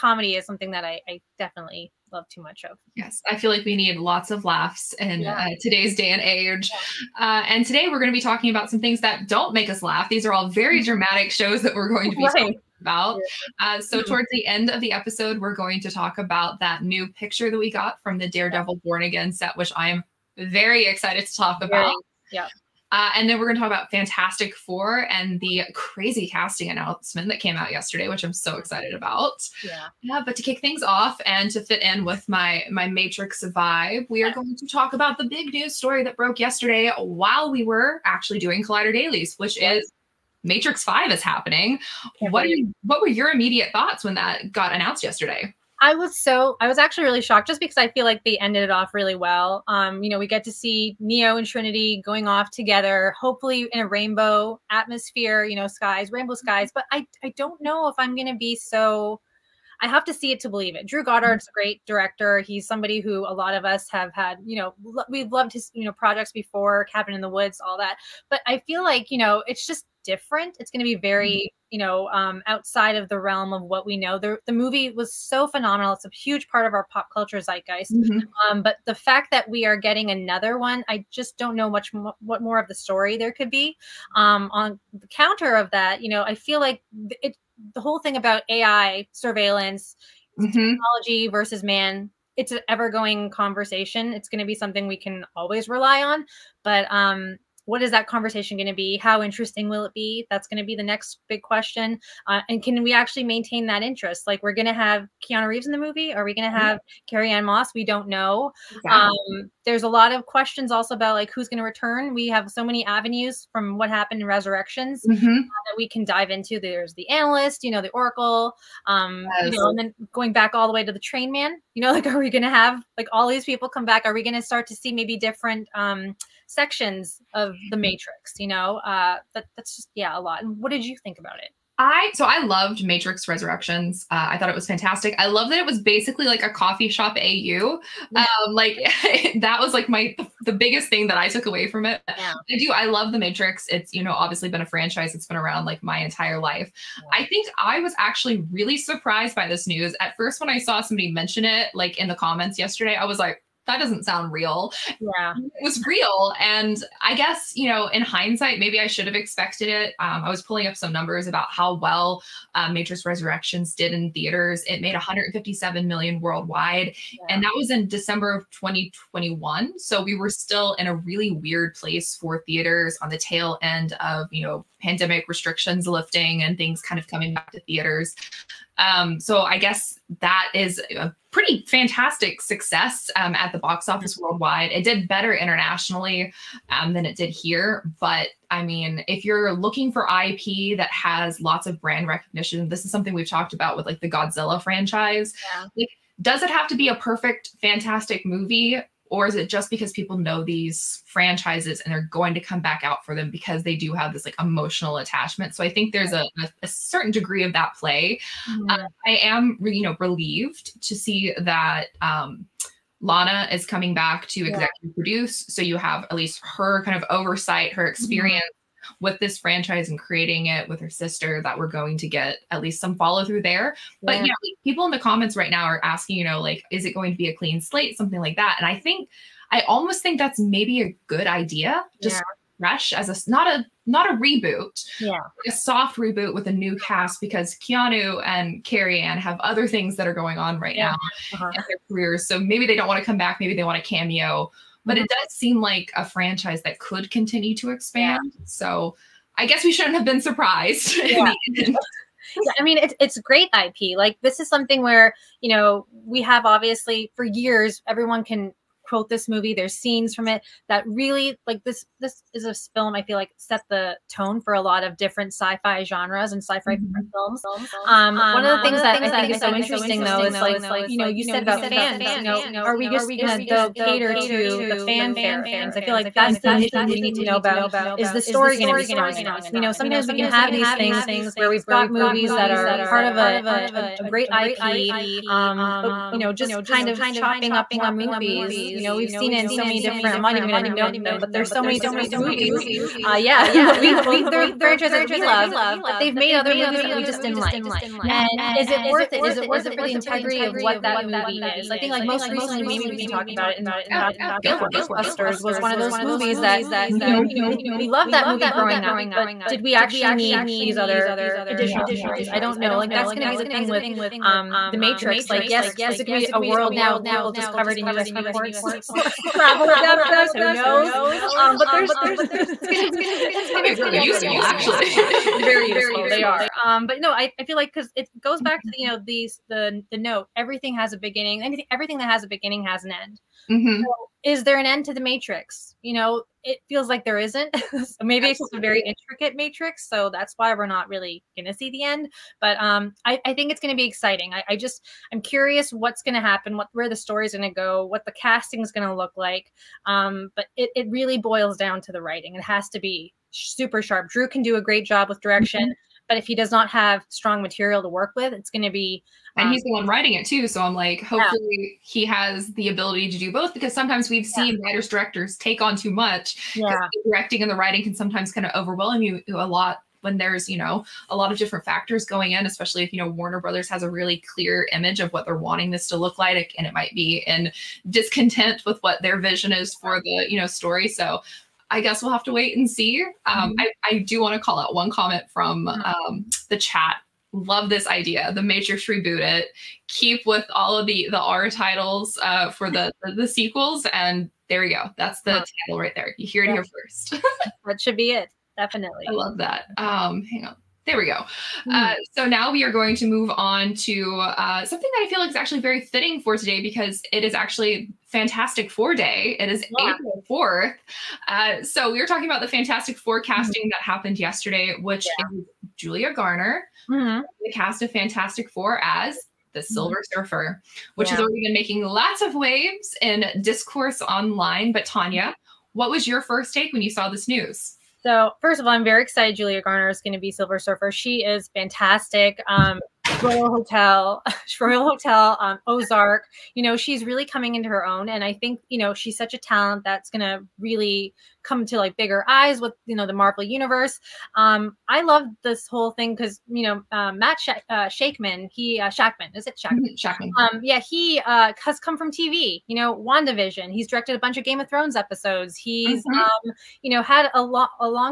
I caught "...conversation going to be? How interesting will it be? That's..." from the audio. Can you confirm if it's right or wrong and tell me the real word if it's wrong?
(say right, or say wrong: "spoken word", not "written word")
right.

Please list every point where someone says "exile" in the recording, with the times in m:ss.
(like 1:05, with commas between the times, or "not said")
not said.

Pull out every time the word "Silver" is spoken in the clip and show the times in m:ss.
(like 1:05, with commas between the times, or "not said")
6:59, 7:10.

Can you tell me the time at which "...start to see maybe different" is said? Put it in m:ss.
2:04.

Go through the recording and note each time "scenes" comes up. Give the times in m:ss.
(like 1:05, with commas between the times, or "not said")
4:19.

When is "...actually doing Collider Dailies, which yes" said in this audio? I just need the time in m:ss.
0:38.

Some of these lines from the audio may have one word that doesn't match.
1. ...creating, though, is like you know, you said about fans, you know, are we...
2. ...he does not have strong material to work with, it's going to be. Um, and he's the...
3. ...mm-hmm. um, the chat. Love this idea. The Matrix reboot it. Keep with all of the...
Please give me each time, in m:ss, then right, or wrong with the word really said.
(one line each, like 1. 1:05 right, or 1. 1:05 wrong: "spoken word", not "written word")
1. 4:29 wrong: "interesting", not "creating"
2. 5:56 right
3. 6:25 right.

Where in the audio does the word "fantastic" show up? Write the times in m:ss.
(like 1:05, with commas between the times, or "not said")
0:23, 2:14, 3:01, 3:17, 6:48, 6:52, 6:57, 7:11.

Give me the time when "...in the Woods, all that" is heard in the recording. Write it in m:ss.
1:07.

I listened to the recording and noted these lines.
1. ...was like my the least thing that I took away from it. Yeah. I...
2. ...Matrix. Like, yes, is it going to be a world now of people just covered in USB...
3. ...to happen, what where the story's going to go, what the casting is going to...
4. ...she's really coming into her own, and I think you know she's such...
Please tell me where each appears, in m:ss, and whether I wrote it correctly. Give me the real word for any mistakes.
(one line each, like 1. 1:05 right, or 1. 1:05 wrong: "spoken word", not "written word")
1. 2:19 wrong: "biggest", not "least"
2. 5:14 right
3. 5:46 right
4. 7:16 right.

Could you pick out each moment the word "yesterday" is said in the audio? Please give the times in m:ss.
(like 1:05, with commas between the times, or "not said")
0:27, 0:36, 0:45, 2:32, 6:54.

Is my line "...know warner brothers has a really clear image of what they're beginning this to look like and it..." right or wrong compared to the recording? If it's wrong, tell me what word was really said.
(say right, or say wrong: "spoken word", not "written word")
wrong: "wanting", not "beginning".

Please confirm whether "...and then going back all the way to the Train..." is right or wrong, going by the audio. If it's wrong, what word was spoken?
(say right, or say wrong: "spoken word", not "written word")
right.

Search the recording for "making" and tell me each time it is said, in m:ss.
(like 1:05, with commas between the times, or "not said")
7:01.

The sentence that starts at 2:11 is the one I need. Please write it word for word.
I so I loved Matrix Resurrections.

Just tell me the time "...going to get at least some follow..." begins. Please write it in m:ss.
3:41.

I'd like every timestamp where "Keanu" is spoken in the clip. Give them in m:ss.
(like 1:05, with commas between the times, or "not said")
1:45, 3:57.